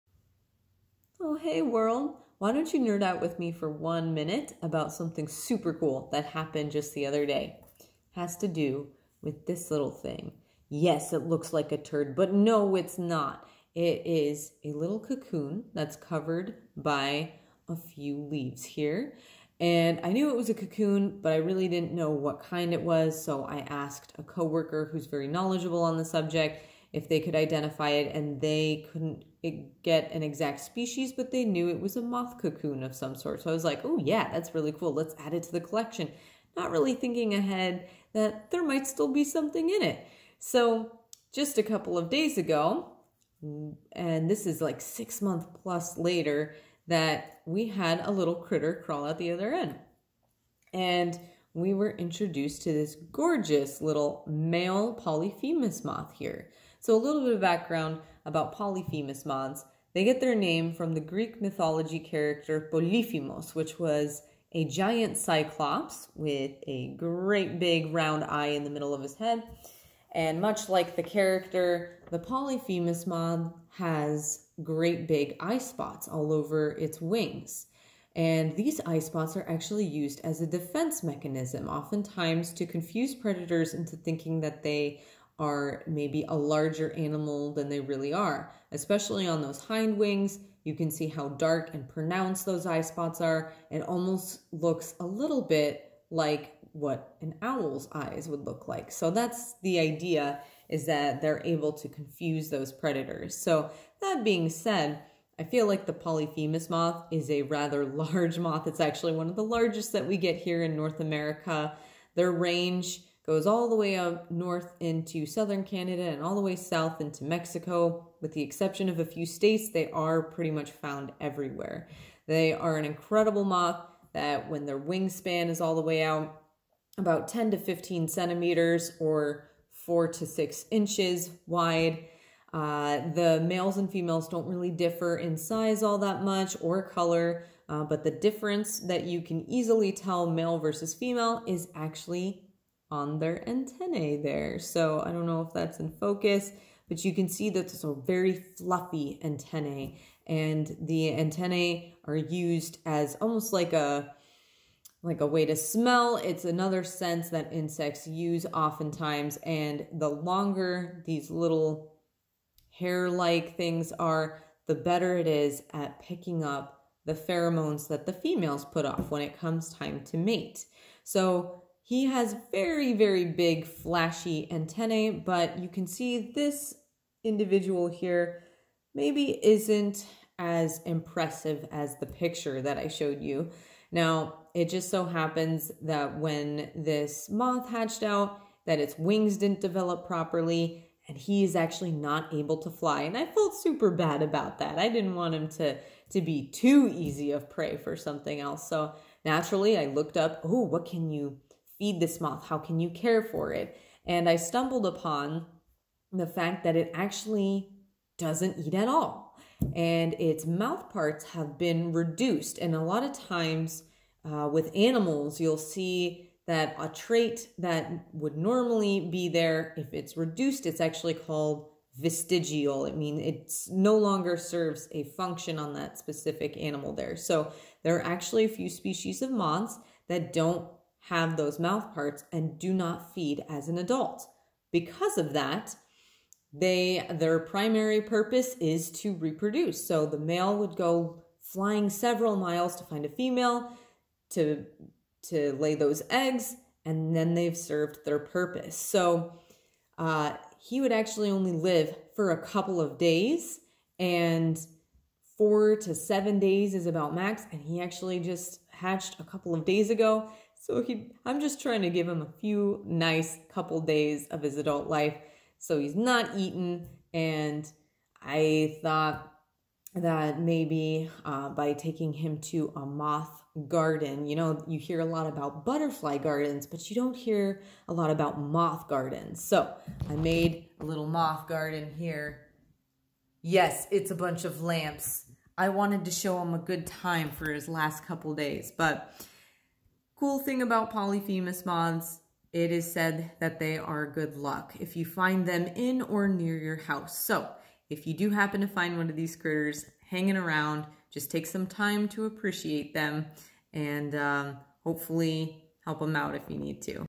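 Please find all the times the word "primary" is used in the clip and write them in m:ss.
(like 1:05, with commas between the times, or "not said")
3:57.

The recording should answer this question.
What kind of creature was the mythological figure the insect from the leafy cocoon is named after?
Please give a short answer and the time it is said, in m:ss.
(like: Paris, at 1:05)
Giant cyclops, at 1:04.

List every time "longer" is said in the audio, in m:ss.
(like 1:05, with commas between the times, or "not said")
2:40, 3:43.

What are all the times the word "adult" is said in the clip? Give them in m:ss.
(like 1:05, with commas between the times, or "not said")
3:53, 4:24.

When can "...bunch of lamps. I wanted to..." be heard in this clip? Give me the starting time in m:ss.
4:44.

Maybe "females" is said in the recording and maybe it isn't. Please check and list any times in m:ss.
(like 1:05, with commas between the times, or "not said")
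2:13, 2:20, 2:48, 4:03.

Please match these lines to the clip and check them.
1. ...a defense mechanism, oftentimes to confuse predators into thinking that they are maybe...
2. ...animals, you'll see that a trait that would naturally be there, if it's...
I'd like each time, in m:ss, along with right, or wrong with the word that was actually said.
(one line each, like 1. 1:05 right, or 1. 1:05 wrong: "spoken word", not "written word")
1. 1:20 right
2. 3:34 wrong: "normally", not "naturally".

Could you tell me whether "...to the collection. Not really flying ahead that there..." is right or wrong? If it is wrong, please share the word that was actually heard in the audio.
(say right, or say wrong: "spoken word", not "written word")
wrong: "thinking", not "flying".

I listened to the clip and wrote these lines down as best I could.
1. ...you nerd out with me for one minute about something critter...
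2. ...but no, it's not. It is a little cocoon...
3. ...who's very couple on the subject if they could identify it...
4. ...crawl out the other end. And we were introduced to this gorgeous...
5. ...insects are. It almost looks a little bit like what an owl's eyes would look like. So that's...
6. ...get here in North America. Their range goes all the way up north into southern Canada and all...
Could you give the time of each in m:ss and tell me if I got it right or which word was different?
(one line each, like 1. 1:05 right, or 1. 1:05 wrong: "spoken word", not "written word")
1. 0:02 wrong: "super", not "critter"
2. 0:12 right
3. 0:24 wrong: "knowledgeable", not "couple"
4. 0:48 right
5. 1:32 wrong: "spots", not "insects"
6. 1:50 right.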